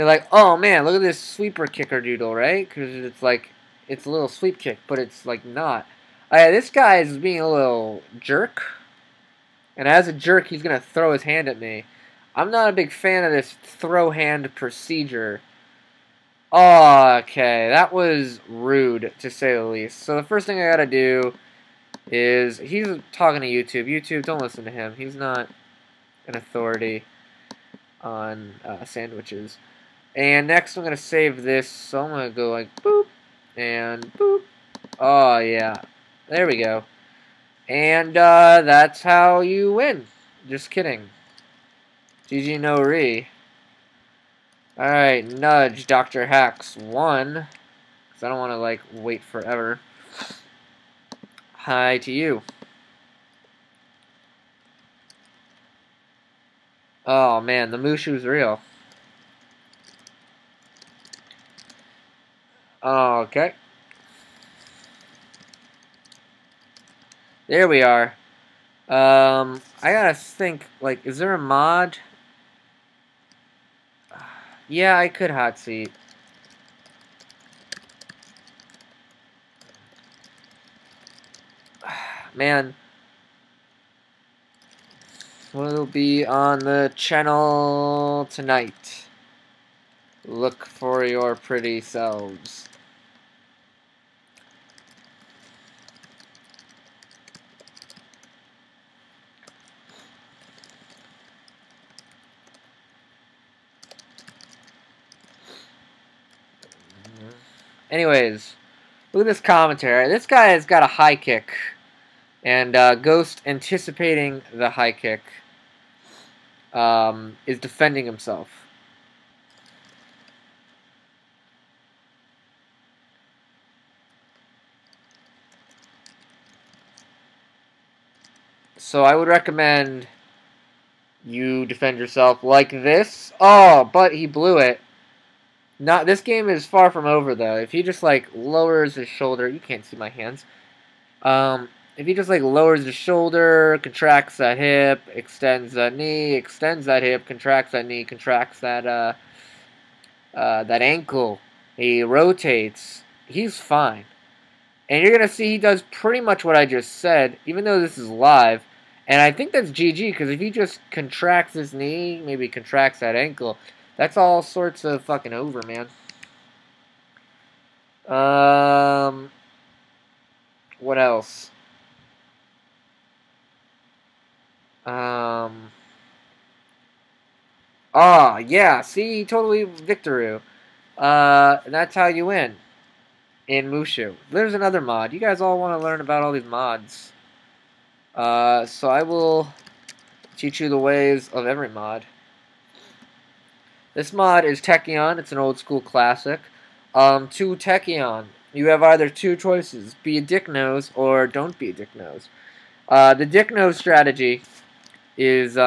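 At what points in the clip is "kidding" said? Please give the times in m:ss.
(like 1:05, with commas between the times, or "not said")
0:40.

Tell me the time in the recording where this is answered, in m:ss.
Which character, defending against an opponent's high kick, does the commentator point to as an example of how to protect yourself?
1:52.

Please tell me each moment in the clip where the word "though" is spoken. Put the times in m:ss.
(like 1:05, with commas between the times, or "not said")
2:17, 2:37.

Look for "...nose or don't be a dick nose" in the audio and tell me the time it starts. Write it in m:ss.
3:20.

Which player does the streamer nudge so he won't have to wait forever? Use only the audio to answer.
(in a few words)
Dr. Hacks 1.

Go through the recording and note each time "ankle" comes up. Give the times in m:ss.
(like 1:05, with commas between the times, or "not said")
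2:30, 2:43.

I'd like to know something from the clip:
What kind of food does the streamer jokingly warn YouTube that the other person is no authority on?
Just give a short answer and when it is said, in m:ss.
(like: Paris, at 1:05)
Sandwiches, at 0:28.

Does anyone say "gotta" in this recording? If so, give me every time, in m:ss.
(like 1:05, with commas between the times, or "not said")
0:20, 1:09.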